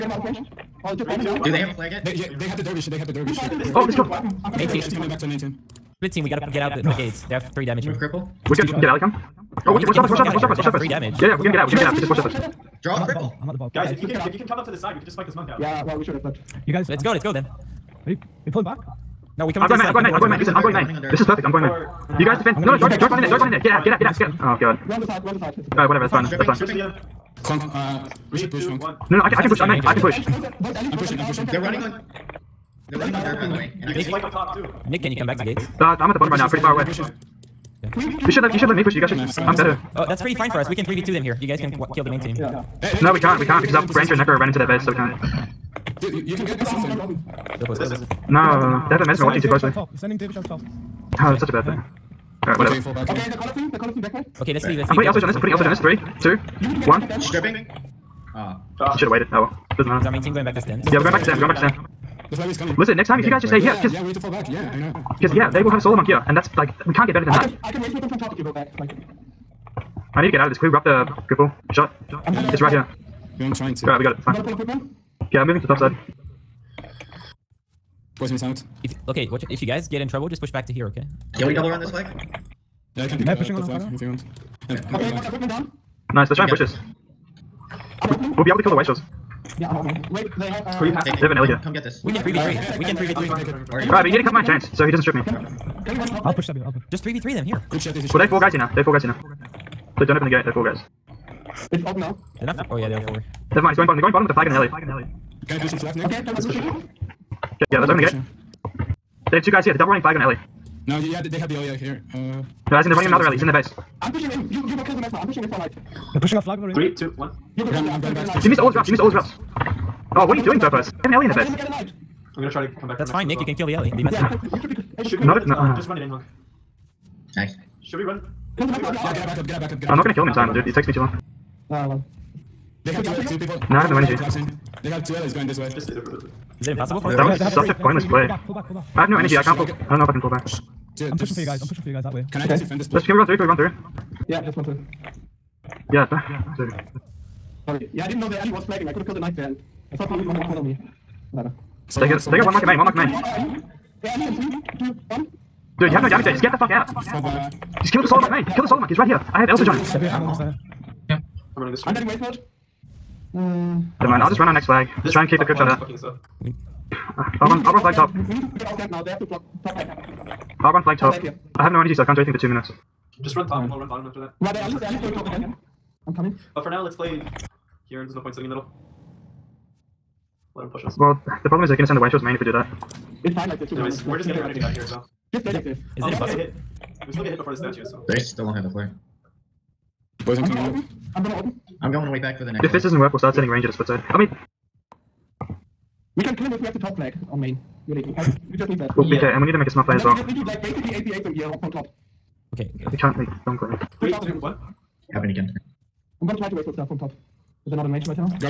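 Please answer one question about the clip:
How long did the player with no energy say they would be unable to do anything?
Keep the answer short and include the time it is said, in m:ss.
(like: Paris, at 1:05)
Two minutes, at 2:52.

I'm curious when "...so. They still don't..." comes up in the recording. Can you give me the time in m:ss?
3:07.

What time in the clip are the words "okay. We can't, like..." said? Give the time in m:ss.
3:22.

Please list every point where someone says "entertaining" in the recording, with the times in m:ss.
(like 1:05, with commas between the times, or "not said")
not said.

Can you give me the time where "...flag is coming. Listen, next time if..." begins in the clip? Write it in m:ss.
1:02.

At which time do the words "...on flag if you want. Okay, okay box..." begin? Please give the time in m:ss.
1:23.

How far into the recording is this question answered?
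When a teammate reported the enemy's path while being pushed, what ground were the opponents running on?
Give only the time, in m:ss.
0:33.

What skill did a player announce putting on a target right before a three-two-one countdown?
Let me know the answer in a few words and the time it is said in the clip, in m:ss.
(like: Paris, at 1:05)
L surge, at 0:55.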